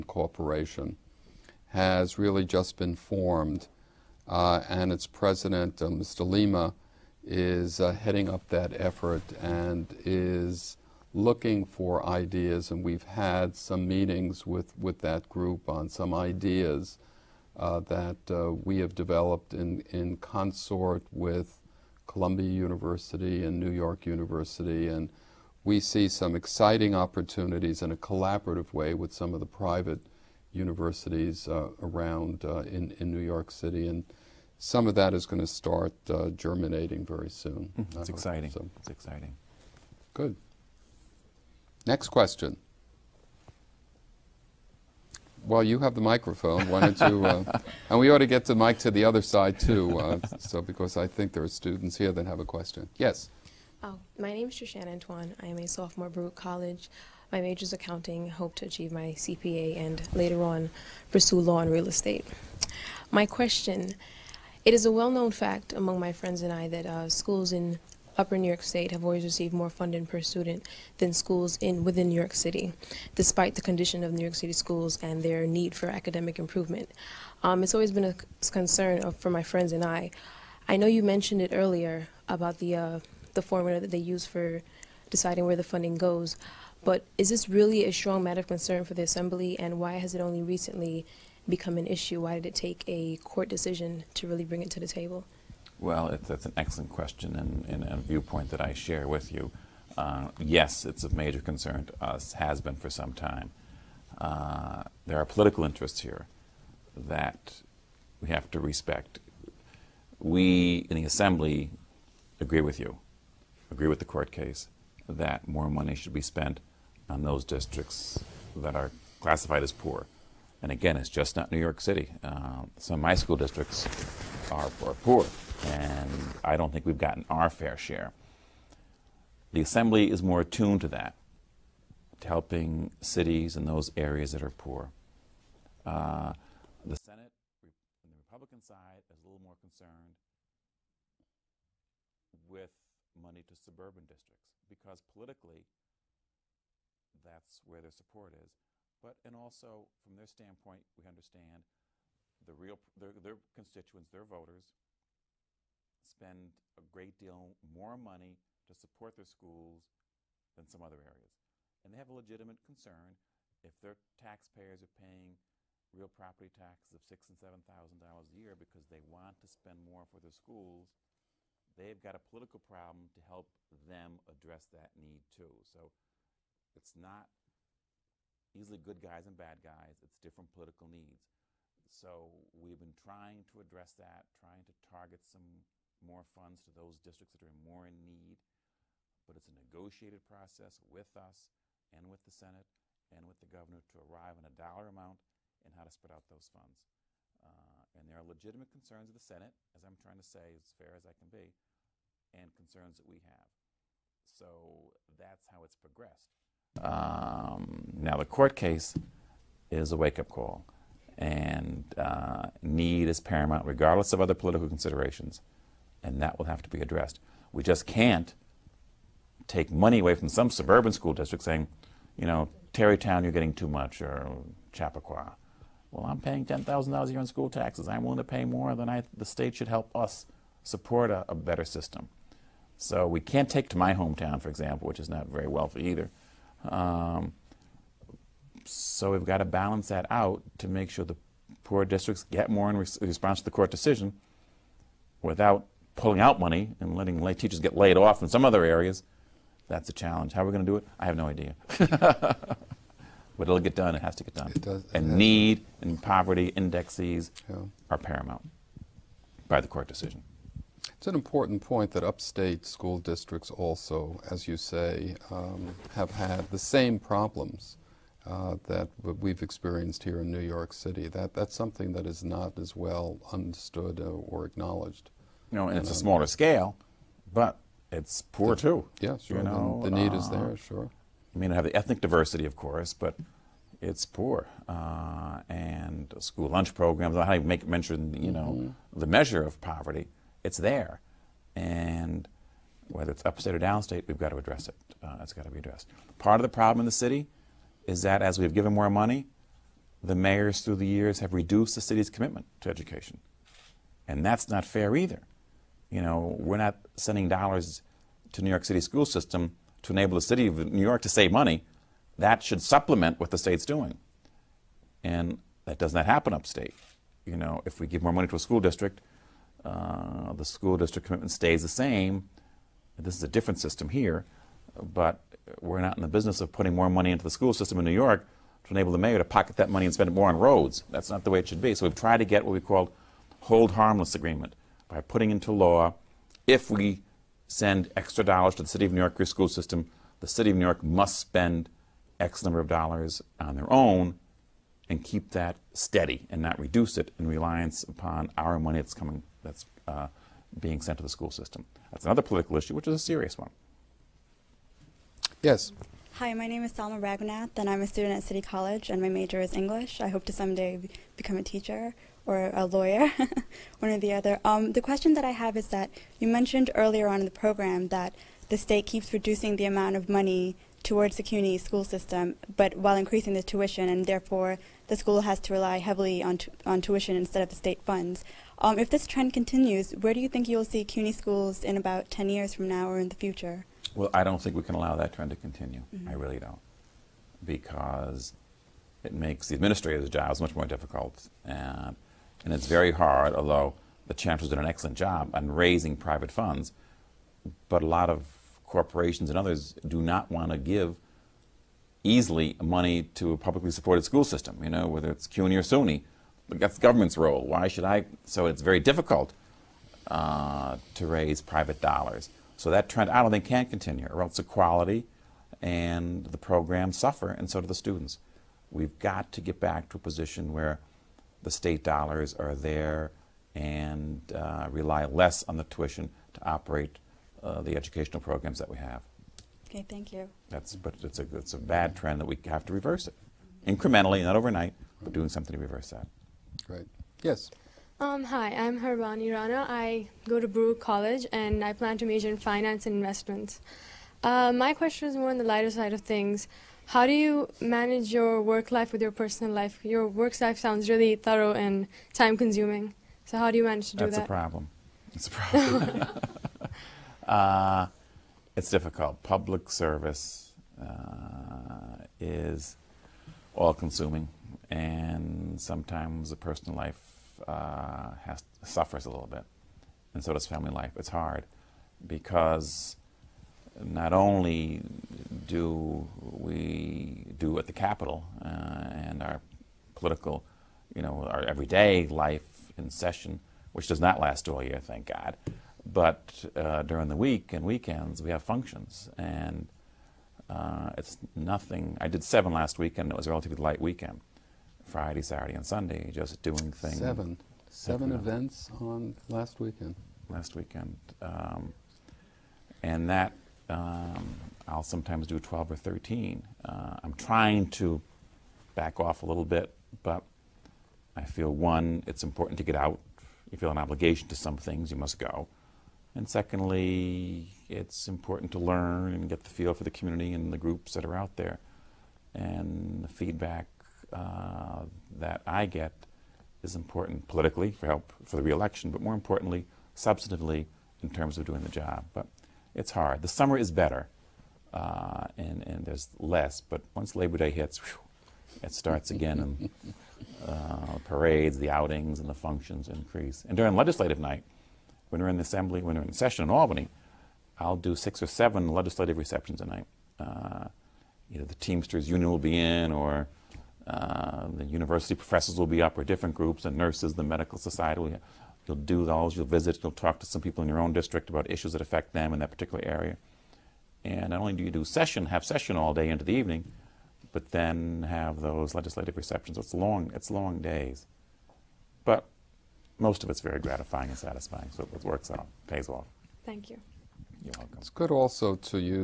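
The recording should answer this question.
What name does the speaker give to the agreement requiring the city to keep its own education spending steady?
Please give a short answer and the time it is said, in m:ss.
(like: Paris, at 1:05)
hold harmless agreement, at 5:33.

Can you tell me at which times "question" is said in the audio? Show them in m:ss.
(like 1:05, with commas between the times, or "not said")
0:42, 0:52, 1:03, 1:36, 6:04, 7:24.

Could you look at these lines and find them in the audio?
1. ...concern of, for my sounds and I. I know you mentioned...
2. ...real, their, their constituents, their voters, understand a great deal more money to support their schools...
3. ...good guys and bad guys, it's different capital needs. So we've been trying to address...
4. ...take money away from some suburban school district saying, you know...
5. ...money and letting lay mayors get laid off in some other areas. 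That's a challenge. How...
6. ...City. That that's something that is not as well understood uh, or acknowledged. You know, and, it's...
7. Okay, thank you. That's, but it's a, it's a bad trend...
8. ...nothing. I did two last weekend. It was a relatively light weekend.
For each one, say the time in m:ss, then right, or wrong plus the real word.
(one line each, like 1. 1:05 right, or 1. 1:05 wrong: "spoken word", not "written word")
1. 1:18 wrong: "friends", not "sounds"
2. 2:32 wrong: "spend", not "understand"
3. 2:58 wrong: "political", not "capital"
4. 3:39 right
5. 4:06 wrong: "teachers", not "mayors"
6. 4:30 right
7. 7:09 right
8. 8:11 wrong: "seven", not "two".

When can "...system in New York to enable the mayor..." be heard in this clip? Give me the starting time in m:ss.
5:27.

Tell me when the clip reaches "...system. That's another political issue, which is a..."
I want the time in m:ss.
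5:51.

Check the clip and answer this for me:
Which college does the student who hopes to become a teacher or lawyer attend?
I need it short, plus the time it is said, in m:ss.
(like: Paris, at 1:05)
City College, at 5:58.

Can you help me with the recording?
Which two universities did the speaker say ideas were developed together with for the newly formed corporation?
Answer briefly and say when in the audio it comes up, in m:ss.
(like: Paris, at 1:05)
Columbia University and New York University, at 0:22.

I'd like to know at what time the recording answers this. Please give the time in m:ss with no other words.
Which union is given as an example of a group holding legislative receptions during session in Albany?
9:11.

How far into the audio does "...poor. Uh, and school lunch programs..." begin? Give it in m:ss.
4:44.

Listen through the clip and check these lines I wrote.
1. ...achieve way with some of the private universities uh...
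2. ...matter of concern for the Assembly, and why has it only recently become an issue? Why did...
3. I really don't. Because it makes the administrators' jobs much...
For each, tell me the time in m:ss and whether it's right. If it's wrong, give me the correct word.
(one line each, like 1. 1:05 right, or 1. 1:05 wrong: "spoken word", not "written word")
1. 0:27 wrong: "collaborative", not "achieve"
2. 1:28 right
3. 6:26 right.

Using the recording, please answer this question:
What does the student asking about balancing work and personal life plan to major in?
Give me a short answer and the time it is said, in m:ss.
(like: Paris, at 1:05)
finance and investments, at 7:22.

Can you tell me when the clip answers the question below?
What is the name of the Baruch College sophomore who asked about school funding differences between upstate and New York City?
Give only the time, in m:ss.
0:54.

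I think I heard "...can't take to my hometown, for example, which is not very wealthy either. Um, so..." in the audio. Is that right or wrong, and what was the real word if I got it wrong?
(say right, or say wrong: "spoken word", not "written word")
right.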